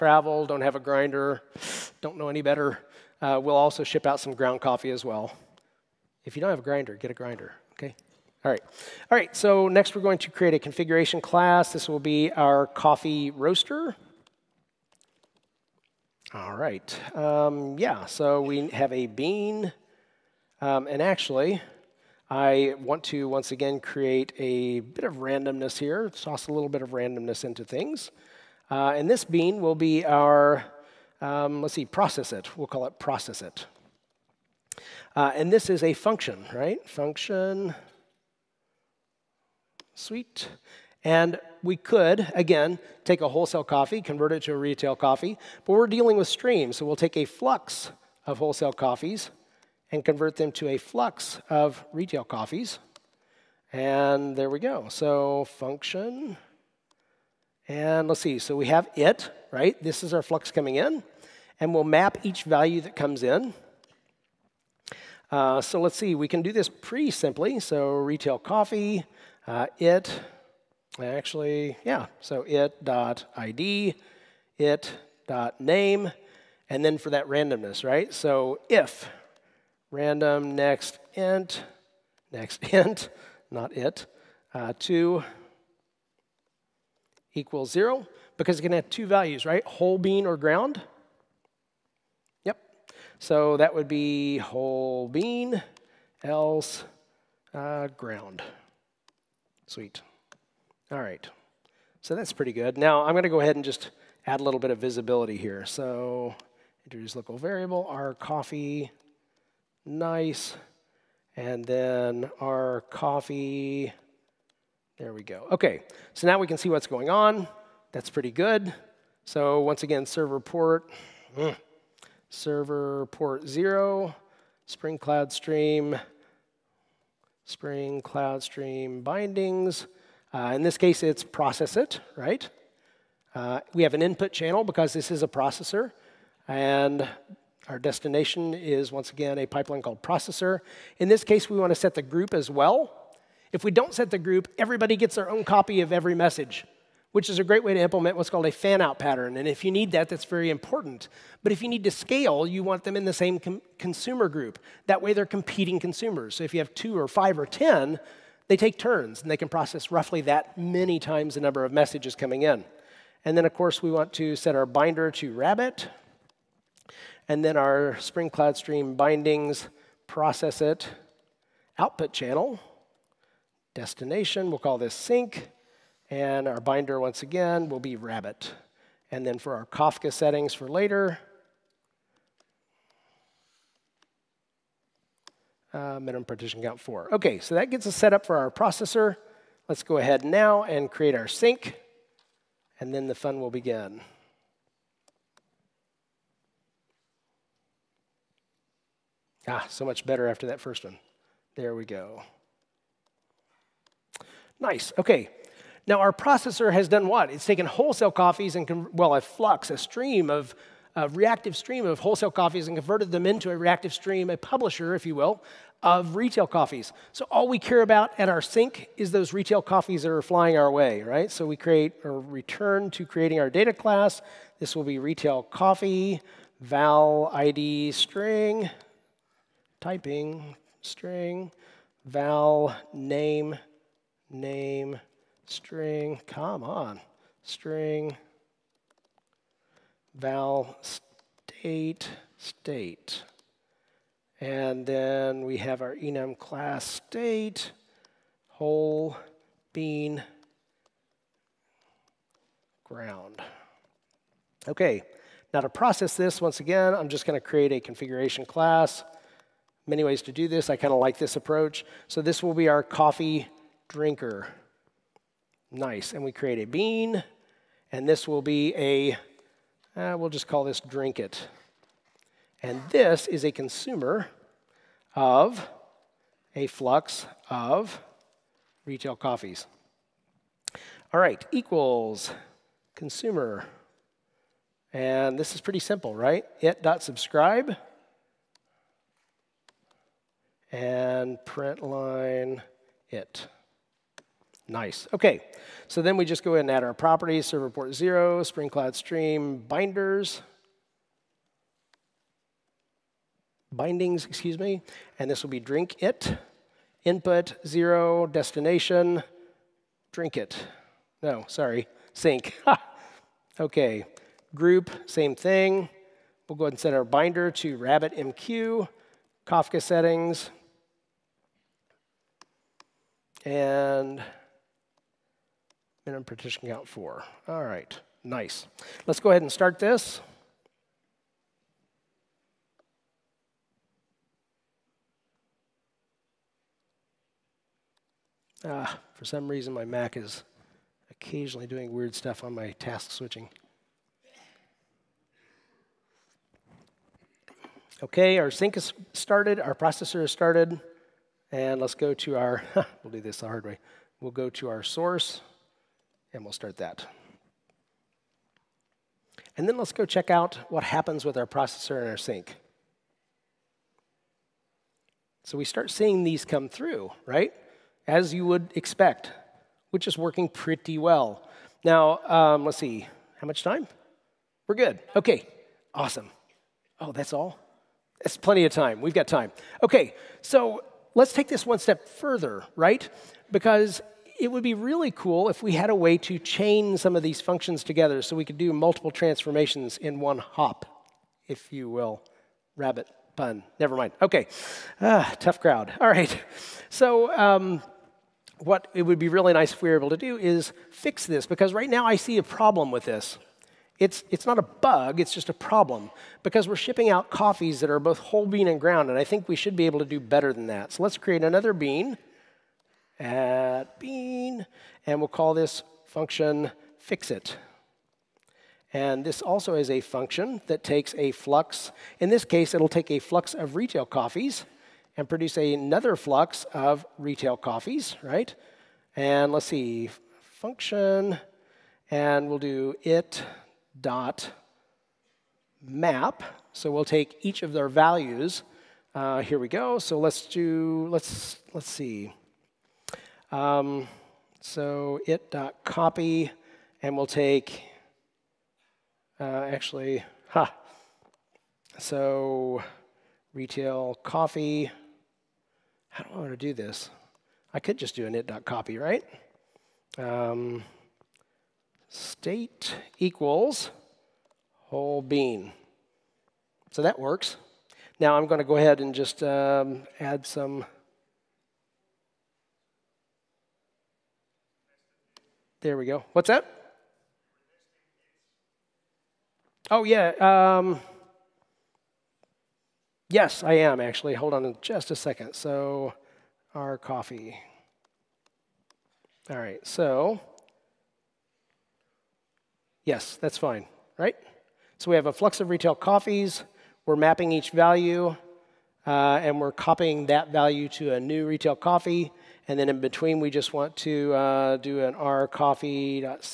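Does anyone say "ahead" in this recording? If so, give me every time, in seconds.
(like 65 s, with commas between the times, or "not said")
103 s, 189 s, 296 s, 316 s, 329 s, 468 s.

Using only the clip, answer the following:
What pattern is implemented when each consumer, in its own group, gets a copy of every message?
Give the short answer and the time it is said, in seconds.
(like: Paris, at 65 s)
fan-out pattern, at 148 s.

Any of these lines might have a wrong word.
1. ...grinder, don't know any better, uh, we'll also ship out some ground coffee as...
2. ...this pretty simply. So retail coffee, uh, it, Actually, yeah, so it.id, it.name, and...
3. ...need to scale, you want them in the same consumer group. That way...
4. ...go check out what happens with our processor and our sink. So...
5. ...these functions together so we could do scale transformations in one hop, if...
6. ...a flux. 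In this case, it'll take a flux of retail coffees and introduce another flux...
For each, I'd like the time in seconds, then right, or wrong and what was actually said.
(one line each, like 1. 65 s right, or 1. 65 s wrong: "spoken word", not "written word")
1. 0 s right
2. 66 s right
3. 151 s right
4. 359 s right
5. 387 s wrong: "multiple", not "scale"
6. 421 s wrong: "produce", not "introduce".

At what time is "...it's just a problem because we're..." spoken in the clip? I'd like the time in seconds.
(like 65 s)
405 s.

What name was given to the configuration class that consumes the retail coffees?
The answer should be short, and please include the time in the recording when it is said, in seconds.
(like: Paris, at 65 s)
coffee drinker, at 262 s.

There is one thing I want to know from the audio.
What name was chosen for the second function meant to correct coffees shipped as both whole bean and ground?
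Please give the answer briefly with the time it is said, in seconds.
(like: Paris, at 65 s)
fixit, at 416 s.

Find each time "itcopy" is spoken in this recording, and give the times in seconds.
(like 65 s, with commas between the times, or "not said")
445 s, 458 s.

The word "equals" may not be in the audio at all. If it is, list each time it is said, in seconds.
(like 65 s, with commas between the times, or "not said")
87 s, 281 s, 463 s.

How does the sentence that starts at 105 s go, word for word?
So introduce local variable, our coffee, nice.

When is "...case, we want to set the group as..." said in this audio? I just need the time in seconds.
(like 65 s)
141 s.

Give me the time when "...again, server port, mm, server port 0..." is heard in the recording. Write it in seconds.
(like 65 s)
119 s.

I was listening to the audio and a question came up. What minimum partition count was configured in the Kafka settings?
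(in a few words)
4.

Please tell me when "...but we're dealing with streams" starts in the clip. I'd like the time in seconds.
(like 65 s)
45 s.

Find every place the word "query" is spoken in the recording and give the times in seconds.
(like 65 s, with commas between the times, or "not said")
not said.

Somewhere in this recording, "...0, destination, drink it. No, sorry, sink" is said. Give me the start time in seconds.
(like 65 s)
307 s.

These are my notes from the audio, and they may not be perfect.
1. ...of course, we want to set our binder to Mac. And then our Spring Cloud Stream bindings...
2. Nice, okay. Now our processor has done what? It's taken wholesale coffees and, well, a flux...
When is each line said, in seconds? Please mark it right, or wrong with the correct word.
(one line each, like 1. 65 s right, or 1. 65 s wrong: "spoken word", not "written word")
1. 163 s wrong: "Rabbit", not "Mac"
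2. 204 s right.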